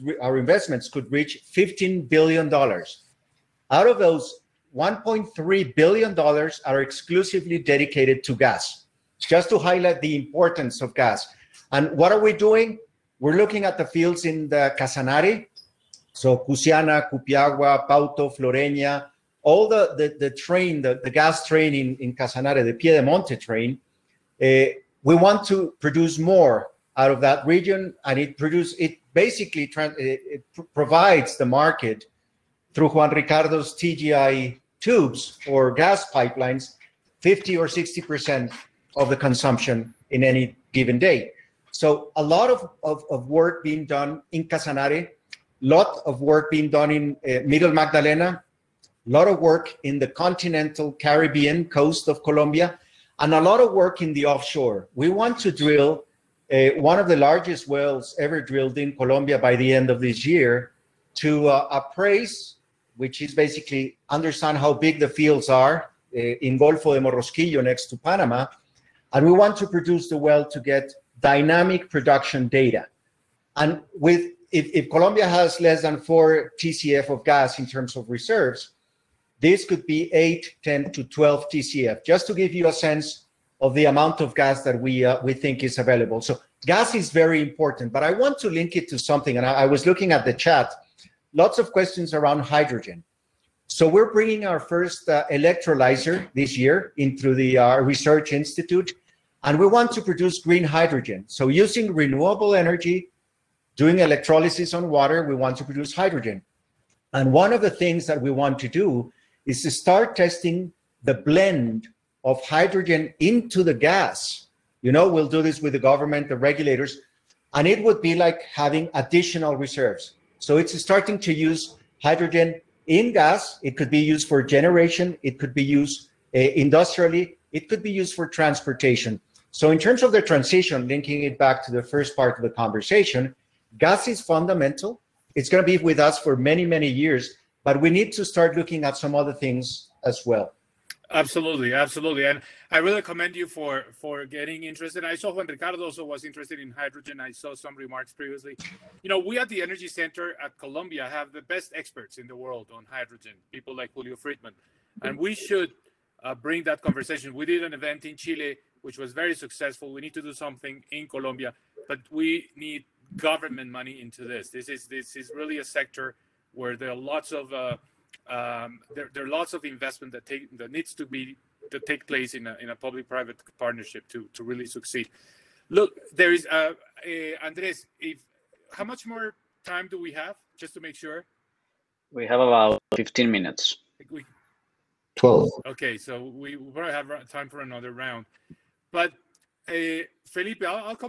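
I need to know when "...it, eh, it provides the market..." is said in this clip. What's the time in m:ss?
0:29.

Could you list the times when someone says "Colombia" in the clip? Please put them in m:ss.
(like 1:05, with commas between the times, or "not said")
0:52, 0:58, 1:14, 2:41.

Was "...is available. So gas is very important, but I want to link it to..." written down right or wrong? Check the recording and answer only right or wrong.
right.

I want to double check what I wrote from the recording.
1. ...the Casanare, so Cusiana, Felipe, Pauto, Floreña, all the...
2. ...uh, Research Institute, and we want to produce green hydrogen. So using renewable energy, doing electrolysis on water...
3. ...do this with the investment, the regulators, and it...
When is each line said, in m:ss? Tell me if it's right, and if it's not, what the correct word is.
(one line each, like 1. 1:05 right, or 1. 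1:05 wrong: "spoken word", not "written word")
1. 0:14 wrong: "Cupiagua", not "Felipe"
2. 1:37 right
3. 1:55 wrong: "government", not "investment".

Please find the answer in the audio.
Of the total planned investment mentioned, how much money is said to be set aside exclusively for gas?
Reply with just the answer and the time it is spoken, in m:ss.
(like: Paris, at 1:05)
$1.3 billion, at 0:04.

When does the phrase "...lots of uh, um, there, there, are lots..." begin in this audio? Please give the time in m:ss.
2:46.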